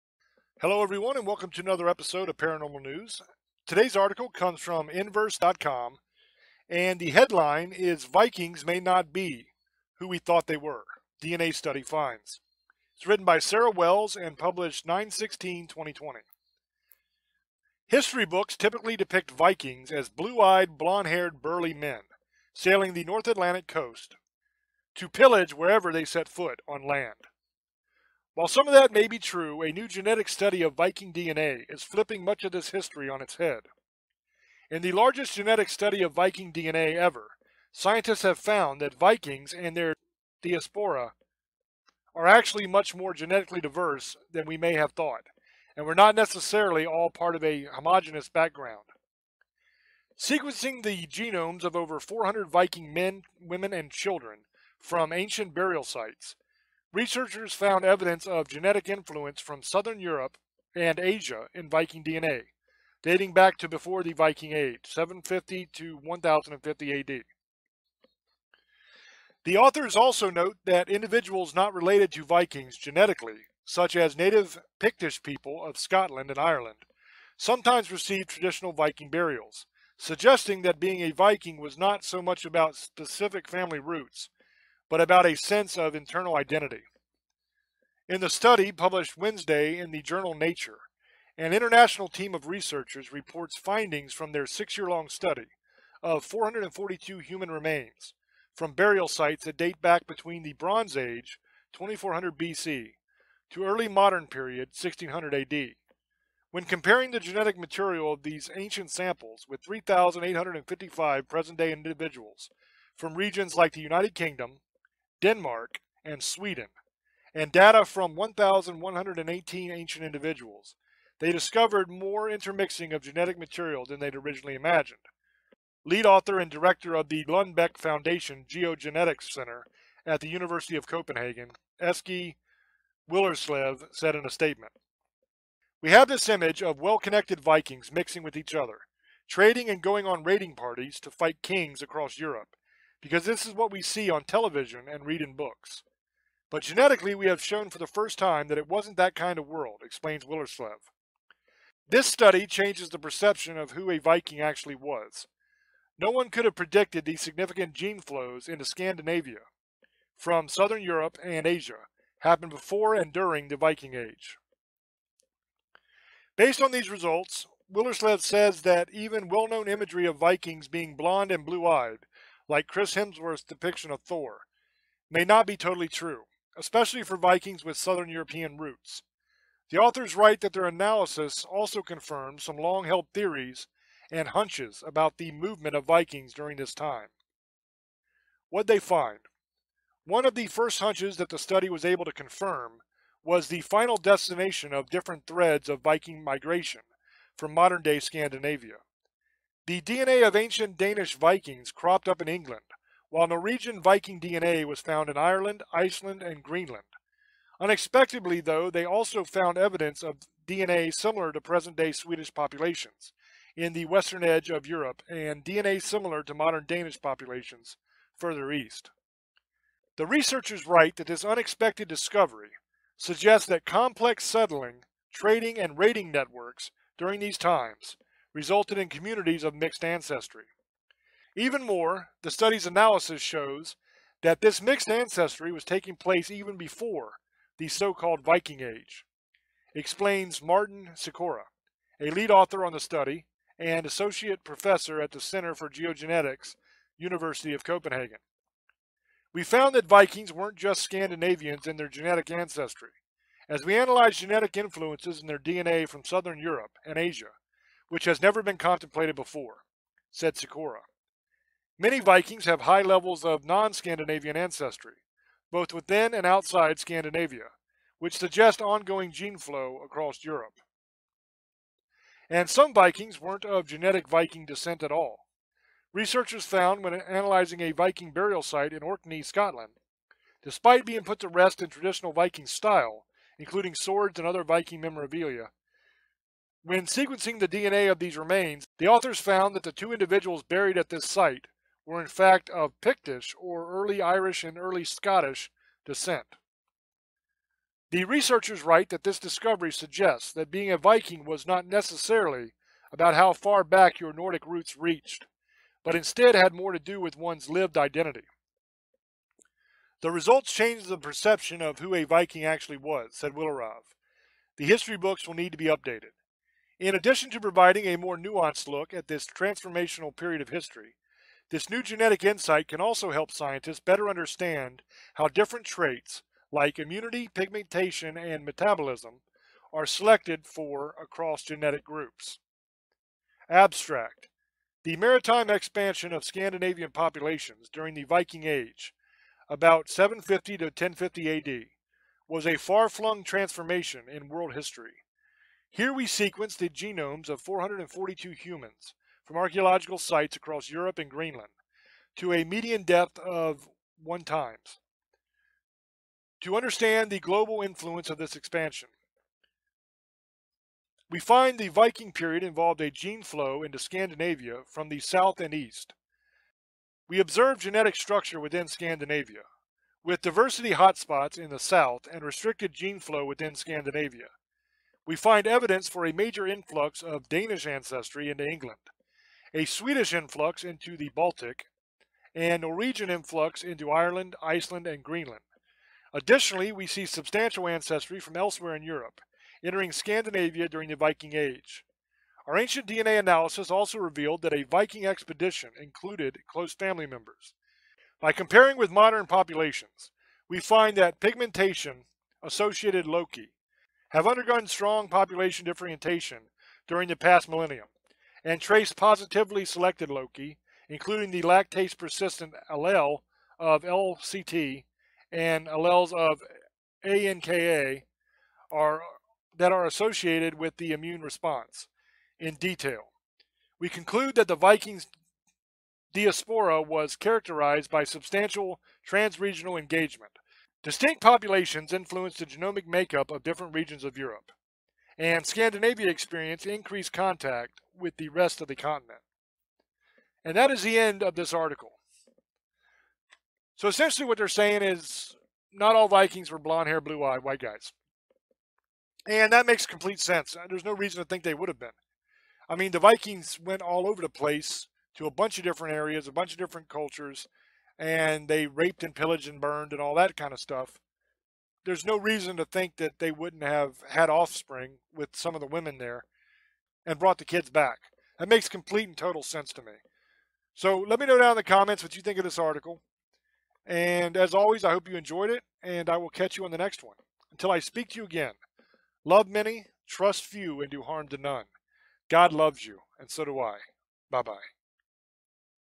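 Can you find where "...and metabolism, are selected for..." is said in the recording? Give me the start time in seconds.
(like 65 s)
328 s.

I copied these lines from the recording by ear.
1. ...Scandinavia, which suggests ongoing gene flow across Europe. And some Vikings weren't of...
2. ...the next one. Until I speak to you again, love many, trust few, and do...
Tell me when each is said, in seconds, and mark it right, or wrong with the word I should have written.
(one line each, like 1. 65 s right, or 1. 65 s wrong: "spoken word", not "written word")
1. 266 s right
2. 476 s right.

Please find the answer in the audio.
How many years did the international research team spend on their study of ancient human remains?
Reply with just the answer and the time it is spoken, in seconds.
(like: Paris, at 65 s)
6, at 94 s.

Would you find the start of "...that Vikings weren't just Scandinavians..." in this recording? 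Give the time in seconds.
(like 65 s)
249 s.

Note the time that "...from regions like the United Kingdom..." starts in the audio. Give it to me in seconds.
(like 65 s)
112 s.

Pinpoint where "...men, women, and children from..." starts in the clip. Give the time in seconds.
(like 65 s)
52 s.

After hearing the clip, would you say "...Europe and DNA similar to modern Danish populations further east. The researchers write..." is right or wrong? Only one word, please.
right.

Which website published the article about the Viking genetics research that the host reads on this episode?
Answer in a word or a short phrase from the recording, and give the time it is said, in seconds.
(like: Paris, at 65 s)
Inverse.com, at 4 s.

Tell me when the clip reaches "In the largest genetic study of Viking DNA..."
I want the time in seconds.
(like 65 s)
34 s.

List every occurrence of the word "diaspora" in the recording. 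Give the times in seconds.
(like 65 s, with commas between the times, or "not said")
40 s, 426 s.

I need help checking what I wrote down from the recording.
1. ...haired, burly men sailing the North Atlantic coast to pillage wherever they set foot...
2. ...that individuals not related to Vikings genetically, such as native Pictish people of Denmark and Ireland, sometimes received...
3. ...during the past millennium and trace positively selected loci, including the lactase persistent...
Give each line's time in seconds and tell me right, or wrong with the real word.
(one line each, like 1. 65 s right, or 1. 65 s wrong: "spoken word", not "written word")
1. 21 s right
2. 70 s wrong: "Scotland", not "Denmark"
3. 406 s right.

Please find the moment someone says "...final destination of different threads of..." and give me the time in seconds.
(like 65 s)
193 s.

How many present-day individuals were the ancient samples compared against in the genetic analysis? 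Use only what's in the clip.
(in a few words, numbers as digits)
3,855.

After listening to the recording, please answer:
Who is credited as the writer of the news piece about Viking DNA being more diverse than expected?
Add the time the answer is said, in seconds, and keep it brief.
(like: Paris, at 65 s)
Sarah Wells, at 13 s.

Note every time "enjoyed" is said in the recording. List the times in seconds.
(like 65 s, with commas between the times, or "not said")
475 s.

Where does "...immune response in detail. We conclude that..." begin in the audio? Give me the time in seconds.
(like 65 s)
420 s.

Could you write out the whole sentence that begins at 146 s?
But genetically, we have shown for the first time that it wasn't that kind of world, explains Willerslev.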